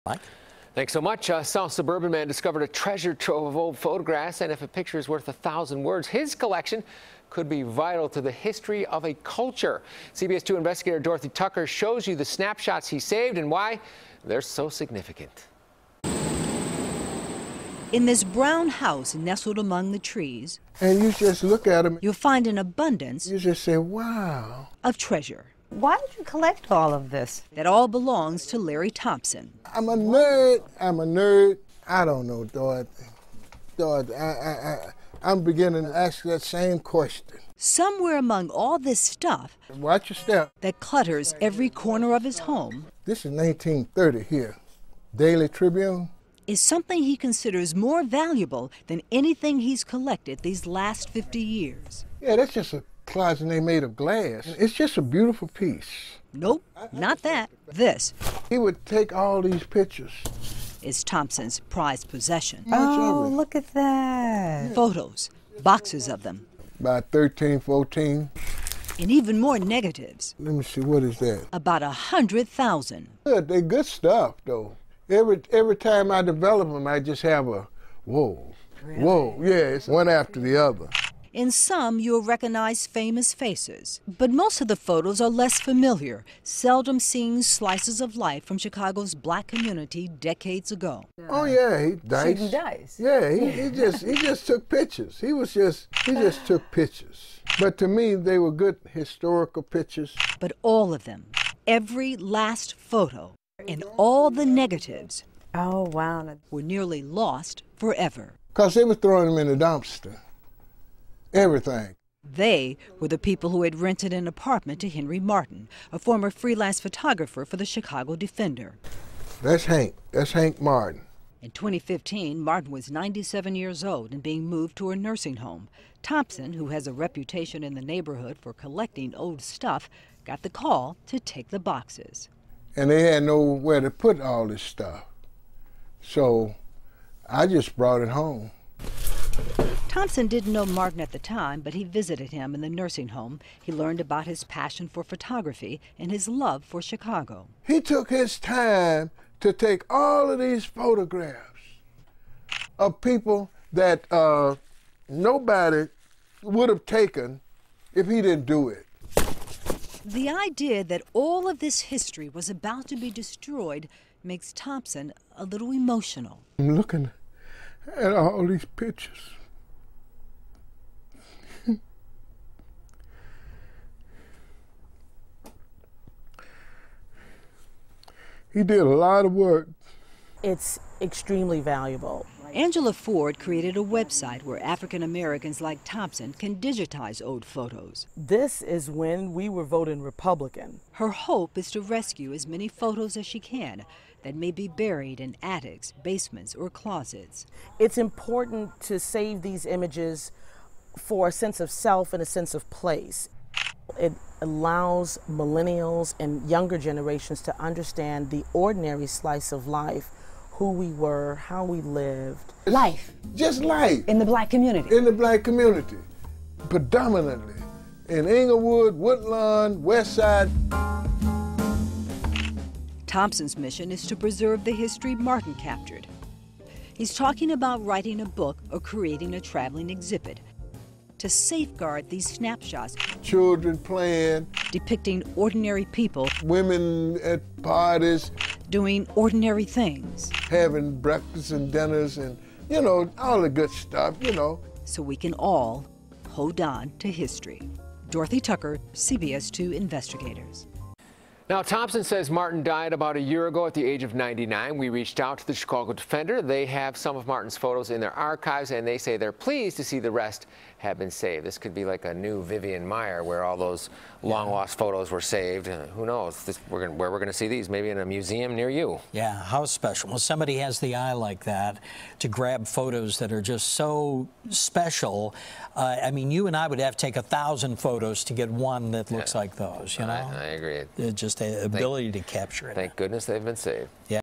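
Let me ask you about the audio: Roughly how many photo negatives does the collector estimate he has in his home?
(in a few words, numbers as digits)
100,000.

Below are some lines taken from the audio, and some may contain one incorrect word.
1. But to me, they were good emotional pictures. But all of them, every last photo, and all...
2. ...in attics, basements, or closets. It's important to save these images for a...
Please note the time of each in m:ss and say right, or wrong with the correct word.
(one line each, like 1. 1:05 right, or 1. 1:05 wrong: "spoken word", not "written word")
1. 1:37 wrong: "historical", not "emotional"
2. 3:15 right.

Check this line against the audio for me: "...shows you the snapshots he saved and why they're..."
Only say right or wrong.
right.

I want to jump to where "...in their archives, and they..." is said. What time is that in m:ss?
4:17.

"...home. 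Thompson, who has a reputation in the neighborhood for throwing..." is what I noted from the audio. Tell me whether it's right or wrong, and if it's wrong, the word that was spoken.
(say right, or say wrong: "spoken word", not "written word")
wrong: "collecting", not "throwing".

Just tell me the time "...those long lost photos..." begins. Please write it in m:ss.
4:23.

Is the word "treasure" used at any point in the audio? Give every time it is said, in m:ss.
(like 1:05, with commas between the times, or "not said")
0:02, 0:24.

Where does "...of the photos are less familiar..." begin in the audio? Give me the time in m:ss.
1:24.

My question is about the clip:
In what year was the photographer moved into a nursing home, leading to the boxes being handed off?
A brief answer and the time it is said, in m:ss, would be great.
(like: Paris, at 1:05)
2015, at 2:01.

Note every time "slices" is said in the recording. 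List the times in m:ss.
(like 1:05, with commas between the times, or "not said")
1:27, 3:29.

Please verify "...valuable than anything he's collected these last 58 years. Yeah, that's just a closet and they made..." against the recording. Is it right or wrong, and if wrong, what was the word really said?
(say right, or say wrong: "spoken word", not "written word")
wrong: "50", not "58".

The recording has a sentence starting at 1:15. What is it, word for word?
Every, every time I develop them, I just have a whoa, really?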